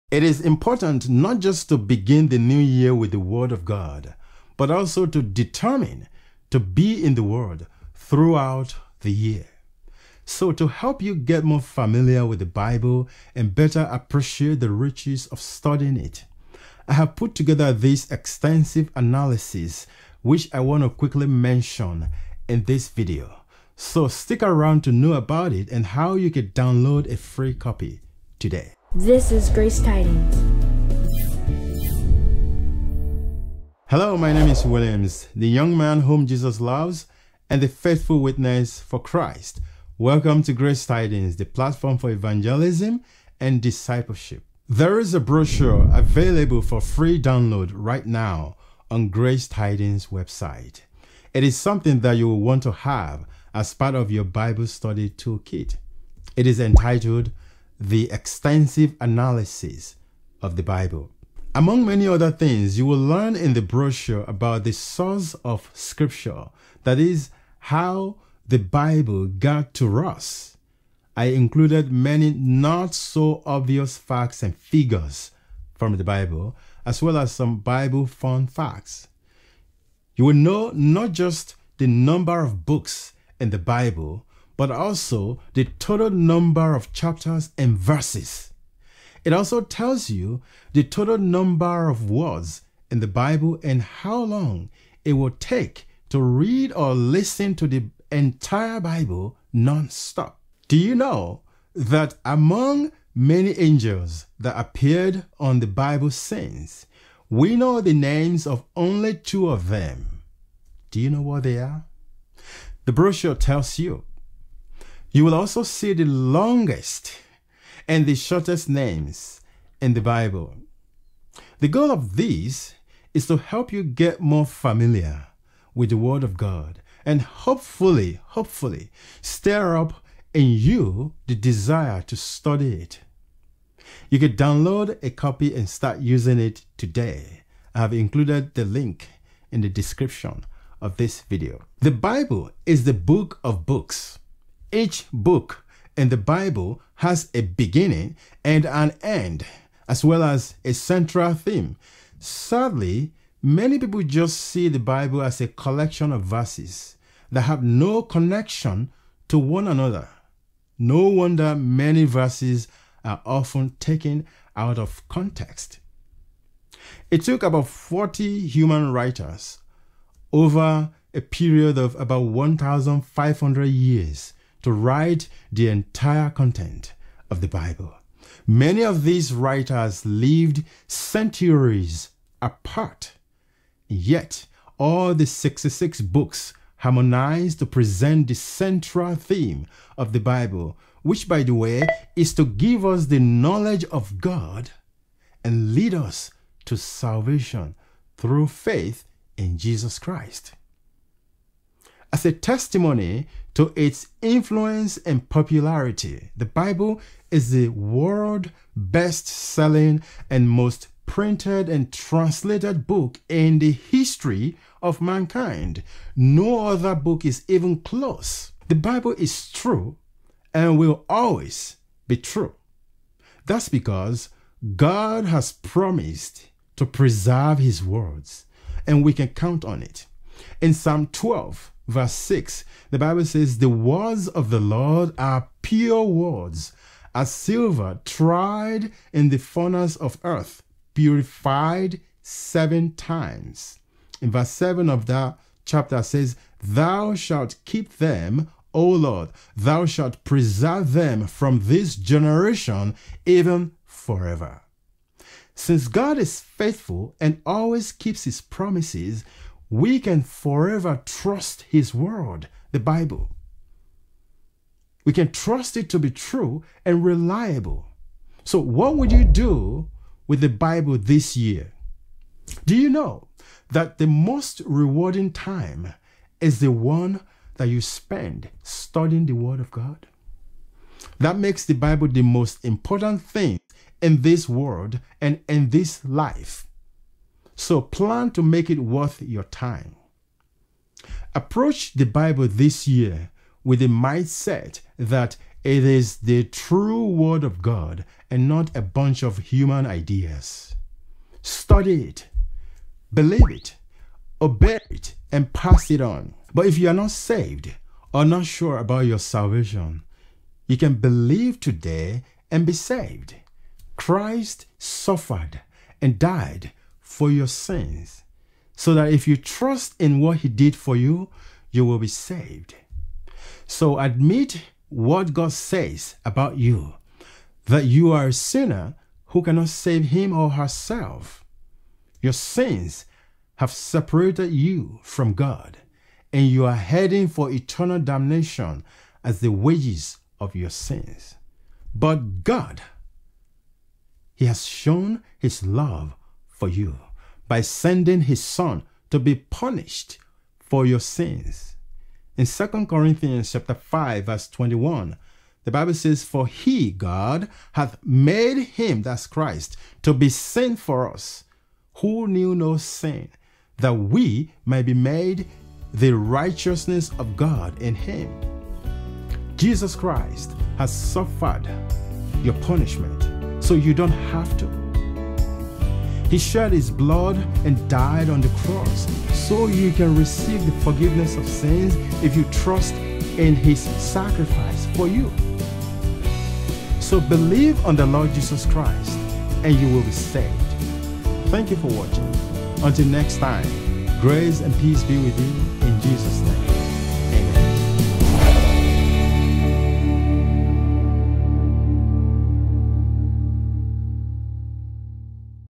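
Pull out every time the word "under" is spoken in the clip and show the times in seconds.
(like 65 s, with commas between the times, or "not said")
not said.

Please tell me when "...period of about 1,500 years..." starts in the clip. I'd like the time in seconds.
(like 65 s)
171 s.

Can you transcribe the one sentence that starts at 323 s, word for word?
So admit what God says about you that you are a sinner who cannot save him or herself.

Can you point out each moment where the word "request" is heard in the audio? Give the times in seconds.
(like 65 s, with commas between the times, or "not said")
not said.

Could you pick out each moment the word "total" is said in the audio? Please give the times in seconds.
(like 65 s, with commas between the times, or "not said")
85 s, 90 s.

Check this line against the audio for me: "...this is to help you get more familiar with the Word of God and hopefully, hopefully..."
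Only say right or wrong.
right.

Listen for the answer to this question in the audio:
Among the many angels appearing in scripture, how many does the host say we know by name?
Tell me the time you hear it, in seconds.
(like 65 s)
109 s.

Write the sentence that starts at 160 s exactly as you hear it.
No wonder many verses are often taken out of context.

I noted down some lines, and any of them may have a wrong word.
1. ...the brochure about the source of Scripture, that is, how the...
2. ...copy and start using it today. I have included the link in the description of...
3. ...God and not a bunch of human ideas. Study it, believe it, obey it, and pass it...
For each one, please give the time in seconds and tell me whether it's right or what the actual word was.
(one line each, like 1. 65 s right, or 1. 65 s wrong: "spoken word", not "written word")
1. 63 s right
2. 135 s right
3. 297 s right.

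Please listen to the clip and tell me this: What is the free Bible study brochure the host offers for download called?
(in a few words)
The extensive analysis of the Bible.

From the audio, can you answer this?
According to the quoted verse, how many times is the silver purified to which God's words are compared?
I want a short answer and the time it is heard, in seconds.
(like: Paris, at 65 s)
7, at 242 s.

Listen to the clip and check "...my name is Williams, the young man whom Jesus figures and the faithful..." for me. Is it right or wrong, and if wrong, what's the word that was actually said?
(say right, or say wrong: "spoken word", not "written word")
wrong: "loves", not "figures".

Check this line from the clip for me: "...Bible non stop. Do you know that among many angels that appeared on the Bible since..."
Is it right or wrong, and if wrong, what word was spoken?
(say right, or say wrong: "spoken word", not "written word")
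right.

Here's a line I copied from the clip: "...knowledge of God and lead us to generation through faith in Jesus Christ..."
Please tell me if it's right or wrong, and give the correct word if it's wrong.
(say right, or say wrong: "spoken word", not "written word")
wrong: "salvation", not "generation".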